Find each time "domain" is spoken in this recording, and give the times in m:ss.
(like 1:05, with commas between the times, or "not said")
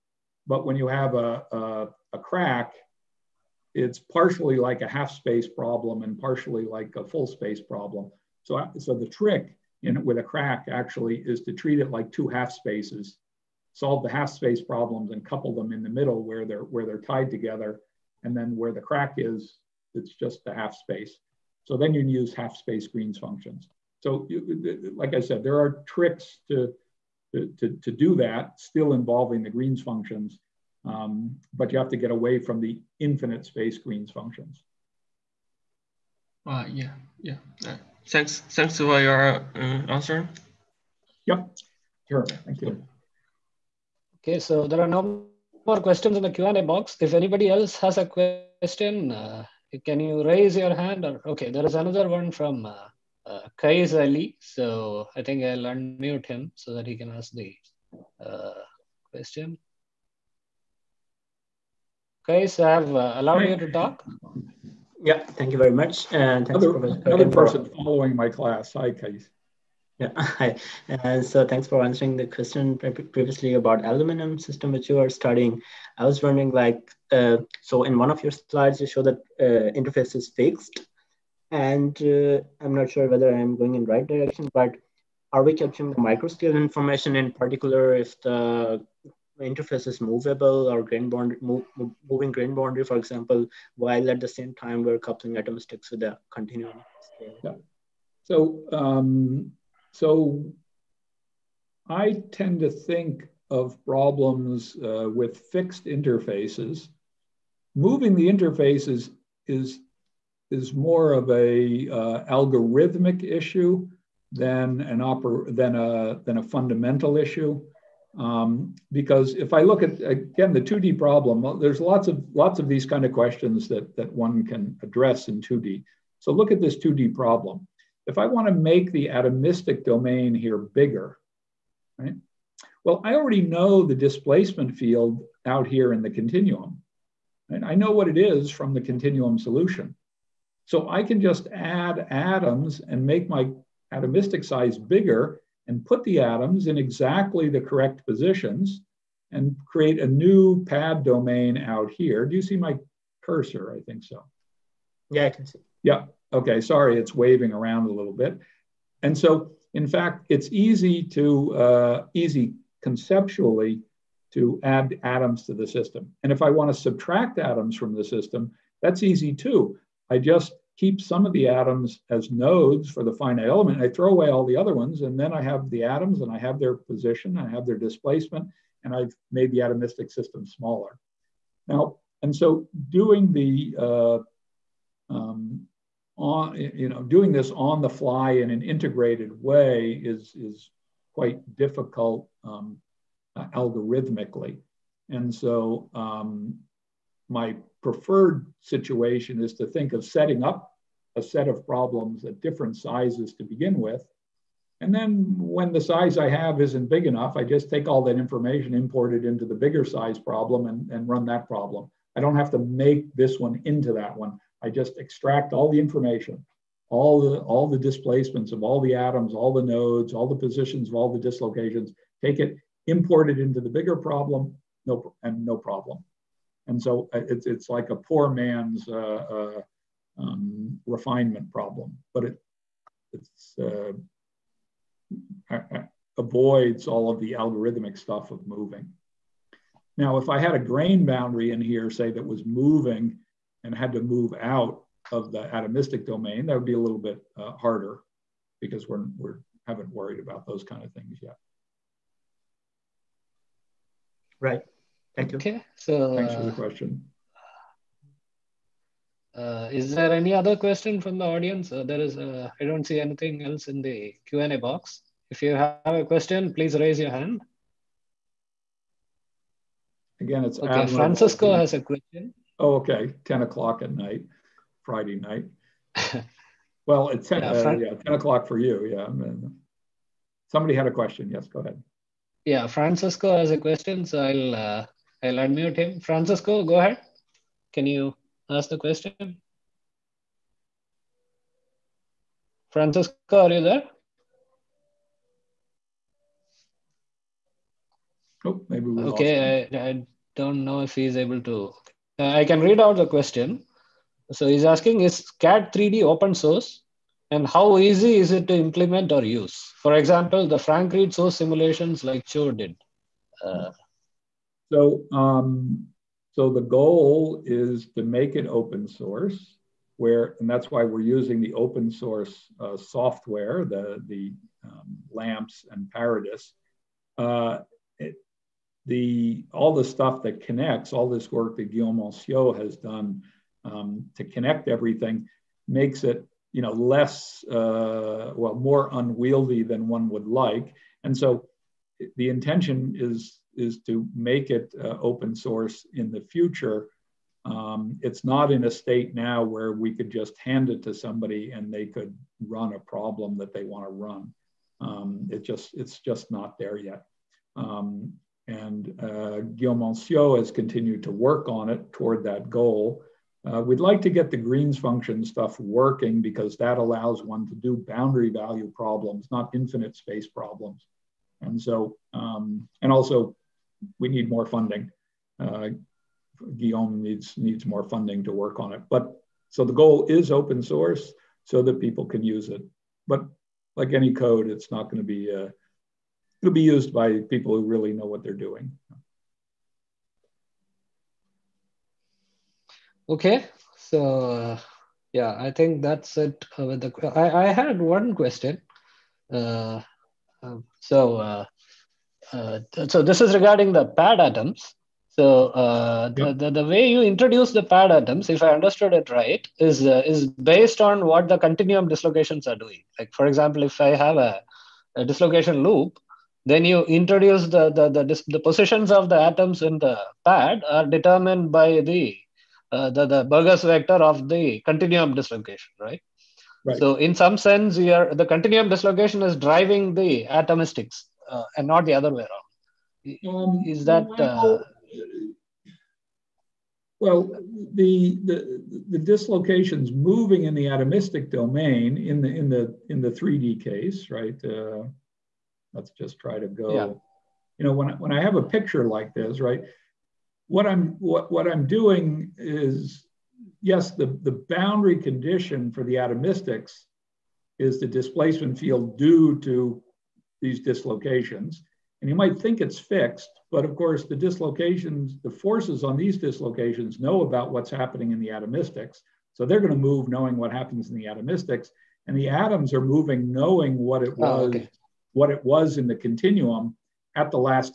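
2:09, 2:31, 4:06, 7:21.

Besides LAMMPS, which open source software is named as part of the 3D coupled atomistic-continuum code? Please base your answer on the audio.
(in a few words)
ParaDiS.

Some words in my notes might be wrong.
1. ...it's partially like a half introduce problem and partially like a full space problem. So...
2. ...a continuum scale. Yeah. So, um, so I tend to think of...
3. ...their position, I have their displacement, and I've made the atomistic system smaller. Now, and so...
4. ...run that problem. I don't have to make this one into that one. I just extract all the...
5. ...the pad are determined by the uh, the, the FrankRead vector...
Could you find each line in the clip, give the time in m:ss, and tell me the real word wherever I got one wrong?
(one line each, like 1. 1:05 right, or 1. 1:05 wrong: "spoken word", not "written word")
1. 0:03 wrong: "space", not "introduce"
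2. 1:36 right
3. 2:56 right
4. 3:31 right
5. 6:59 wrong: "Burgers", not "FrankRead".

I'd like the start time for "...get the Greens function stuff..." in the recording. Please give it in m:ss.
6:04.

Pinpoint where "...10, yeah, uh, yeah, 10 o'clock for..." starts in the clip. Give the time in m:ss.
4:37.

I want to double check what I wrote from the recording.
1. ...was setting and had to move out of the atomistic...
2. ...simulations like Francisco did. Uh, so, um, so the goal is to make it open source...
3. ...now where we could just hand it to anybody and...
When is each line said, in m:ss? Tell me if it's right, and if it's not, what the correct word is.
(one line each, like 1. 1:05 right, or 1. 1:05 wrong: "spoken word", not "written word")
1. 4:02 wrong: "moving", not "setting"
2. 5:11 wrong: "Cho", not "Francisco"
3. 5:49 wrong: "somebody", not "anybody".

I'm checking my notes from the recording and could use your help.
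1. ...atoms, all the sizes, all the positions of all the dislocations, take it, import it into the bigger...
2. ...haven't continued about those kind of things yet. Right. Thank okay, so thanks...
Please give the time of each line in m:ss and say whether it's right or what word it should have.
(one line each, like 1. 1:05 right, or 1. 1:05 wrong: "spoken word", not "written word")
1. 3:38 wrong: "nodes", not "sizes"
2. 4:09 wrong: "worried", not "continued".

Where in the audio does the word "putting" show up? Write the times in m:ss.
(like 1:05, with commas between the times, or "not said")
not said.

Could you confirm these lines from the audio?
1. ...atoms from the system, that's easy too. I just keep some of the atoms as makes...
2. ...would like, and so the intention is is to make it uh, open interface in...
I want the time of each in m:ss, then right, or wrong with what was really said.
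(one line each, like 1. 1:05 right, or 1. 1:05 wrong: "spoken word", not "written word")
1. 2:47 wrong: "nodes", not "makes"
2. 5:40 wrong: "source", not "interface".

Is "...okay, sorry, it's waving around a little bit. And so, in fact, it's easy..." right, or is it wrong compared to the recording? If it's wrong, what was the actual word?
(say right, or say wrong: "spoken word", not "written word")
right.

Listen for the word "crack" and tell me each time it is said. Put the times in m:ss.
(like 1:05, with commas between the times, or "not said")
0:02, 0:10, 0:18.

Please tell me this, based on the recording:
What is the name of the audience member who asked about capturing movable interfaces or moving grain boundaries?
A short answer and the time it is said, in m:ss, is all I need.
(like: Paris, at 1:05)
Kais Ali, at 0:53.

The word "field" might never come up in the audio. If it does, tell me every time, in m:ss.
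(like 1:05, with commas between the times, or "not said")
2:14, 7:38.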